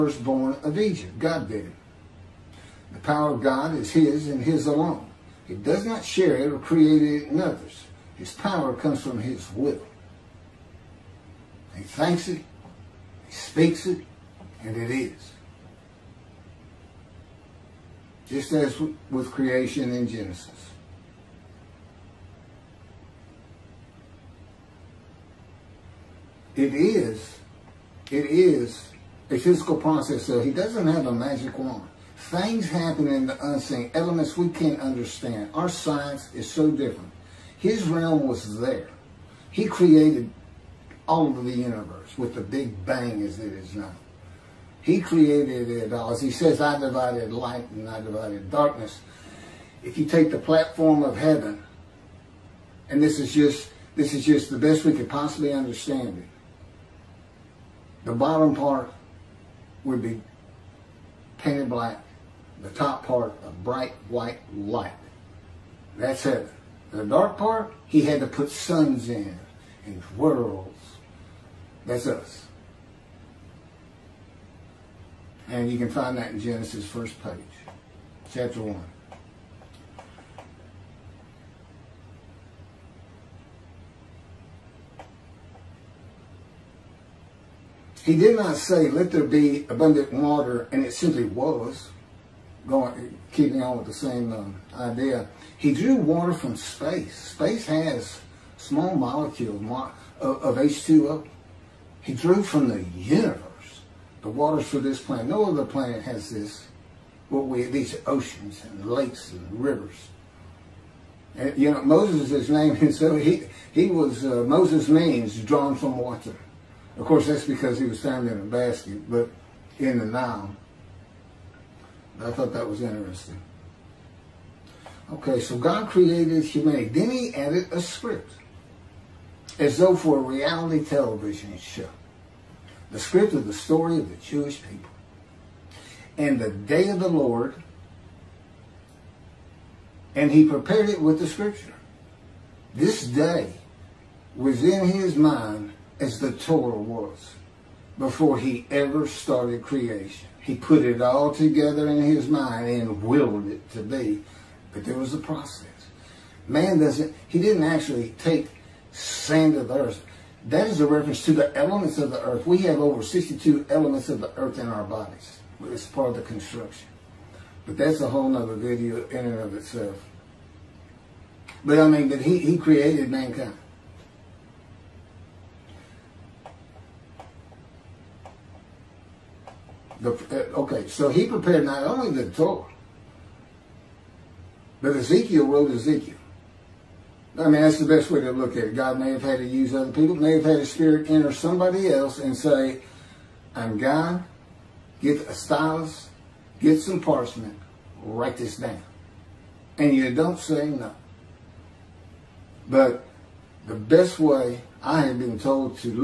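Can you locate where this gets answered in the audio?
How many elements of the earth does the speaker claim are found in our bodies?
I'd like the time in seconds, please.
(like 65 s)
162 s.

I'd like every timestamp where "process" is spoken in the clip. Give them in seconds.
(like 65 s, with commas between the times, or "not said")
29 s, 155 s.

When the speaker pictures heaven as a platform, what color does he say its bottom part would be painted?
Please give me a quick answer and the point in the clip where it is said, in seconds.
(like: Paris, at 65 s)
Black, at 61 s.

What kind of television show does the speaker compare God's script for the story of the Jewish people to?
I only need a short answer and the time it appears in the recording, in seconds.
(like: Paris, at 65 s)
Reality television, at 130 s.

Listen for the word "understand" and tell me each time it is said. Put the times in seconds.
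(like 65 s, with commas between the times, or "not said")
34 s, 55 s.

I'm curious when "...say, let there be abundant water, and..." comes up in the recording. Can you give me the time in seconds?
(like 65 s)
88 s.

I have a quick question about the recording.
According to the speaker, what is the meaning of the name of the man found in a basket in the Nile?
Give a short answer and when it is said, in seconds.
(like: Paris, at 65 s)
Drawn from water, at 115 s.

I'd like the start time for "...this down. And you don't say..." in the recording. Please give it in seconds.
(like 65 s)
198 s.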